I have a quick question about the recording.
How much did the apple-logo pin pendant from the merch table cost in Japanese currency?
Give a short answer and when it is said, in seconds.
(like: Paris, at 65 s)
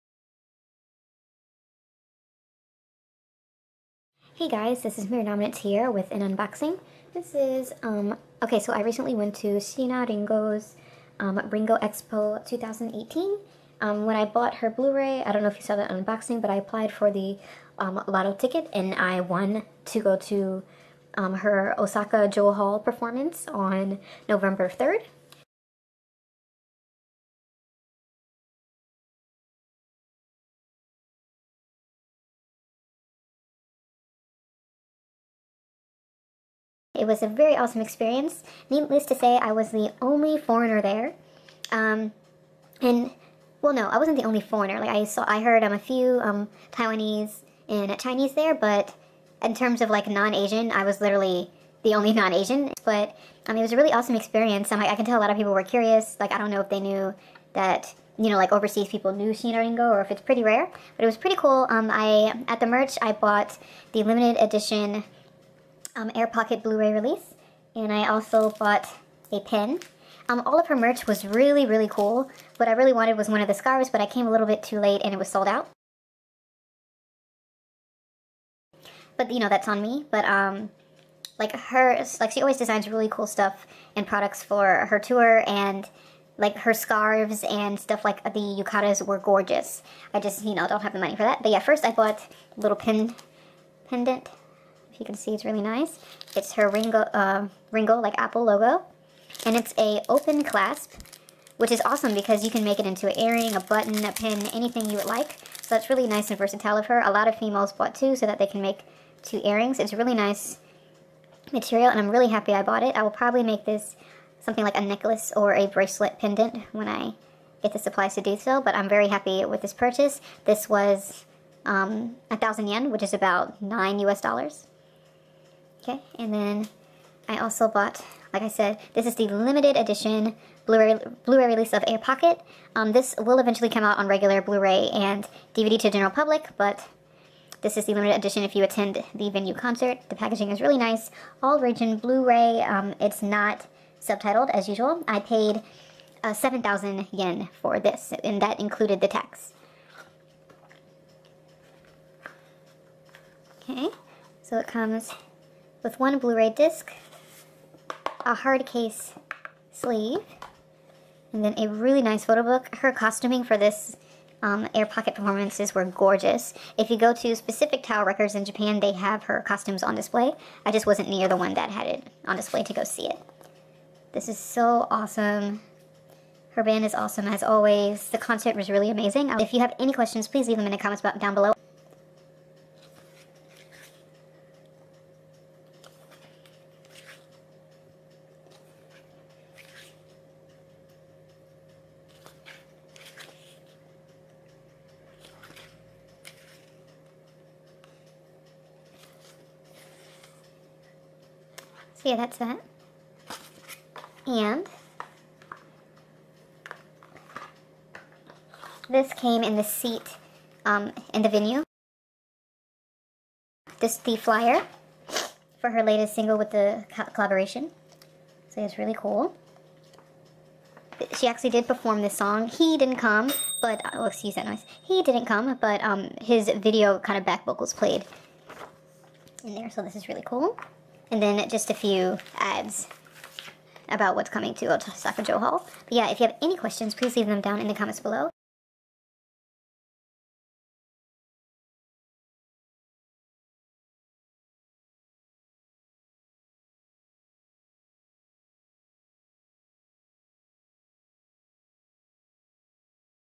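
1,000 yen, at 122 s.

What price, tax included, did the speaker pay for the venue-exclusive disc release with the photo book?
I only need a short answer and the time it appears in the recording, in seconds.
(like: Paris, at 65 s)
7,000 yen, at 146 s.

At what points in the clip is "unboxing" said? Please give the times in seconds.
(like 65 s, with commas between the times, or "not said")
6 s, 15 s.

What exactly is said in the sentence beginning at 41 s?
Um, and, well, no, I wasn't the only foreigner.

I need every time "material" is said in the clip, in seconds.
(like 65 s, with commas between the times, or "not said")
111 s.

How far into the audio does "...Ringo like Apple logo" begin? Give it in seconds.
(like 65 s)
97 s.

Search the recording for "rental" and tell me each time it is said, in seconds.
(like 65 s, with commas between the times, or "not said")
not said.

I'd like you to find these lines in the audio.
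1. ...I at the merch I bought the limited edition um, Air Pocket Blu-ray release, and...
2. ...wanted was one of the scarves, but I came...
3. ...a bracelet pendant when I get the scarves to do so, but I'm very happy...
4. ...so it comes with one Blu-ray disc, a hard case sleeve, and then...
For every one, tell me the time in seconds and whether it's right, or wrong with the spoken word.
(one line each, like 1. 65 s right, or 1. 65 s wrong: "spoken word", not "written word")
1. 61 s right
2. 72 s right
3. 115 s wrong: "supplies", not "scarves"
4. 154 s right.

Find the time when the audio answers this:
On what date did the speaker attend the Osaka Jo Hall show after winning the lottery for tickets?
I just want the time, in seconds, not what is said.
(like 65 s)
24 s.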